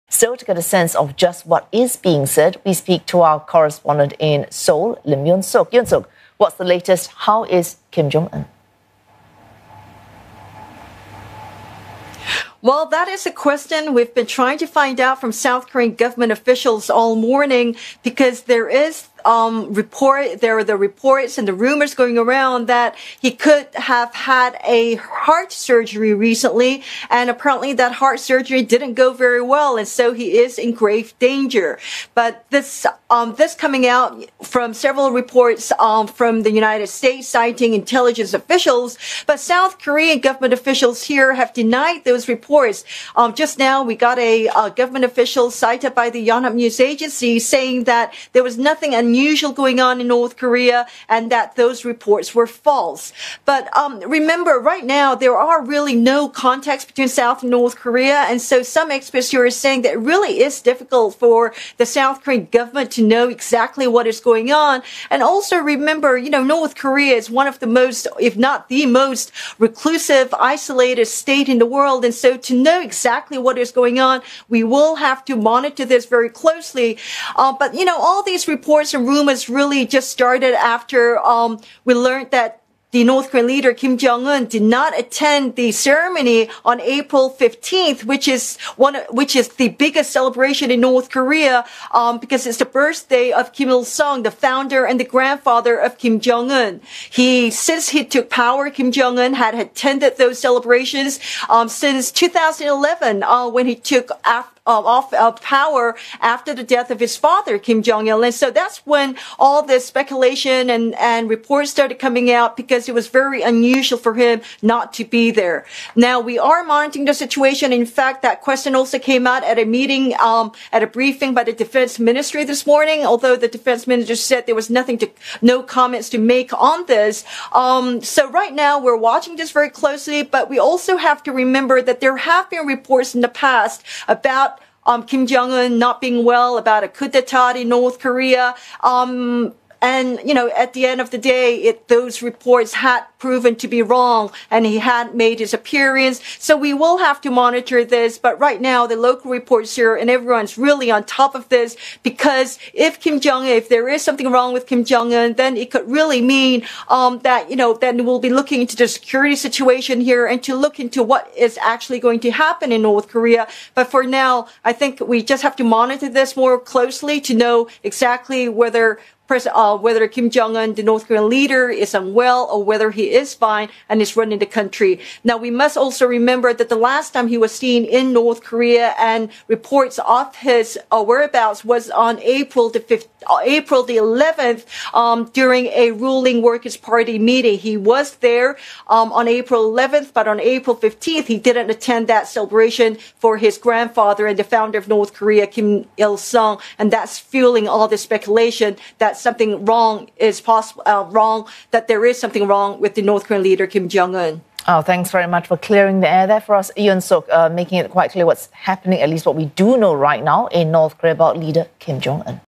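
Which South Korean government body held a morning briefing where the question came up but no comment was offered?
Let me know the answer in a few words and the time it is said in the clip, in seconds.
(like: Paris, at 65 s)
Defense ministry, at 121 s.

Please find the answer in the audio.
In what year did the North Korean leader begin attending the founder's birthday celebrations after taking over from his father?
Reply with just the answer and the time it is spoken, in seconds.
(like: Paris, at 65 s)
2011, at 102 s.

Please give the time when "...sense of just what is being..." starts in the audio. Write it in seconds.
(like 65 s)
0 s.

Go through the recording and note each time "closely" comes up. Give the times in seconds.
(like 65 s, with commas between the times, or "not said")
76 s, 129 s, 166 s.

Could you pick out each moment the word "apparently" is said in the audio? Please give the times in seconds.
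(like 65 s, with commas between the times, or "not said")
27 s.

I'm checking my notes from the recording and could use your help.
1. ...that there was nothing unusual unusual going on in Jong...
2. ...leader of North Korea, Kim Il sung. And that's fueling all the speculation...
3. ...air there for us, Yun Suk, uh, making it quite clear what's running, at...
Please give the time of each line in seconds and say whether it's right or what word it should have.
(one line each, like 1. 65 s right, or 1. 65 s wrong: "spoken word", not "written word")
1. 47 s wrong: "North", not "Jong"
2. 194 s wrong: "founder", not "leader"
3. 206 s wrong: "happening", not "running".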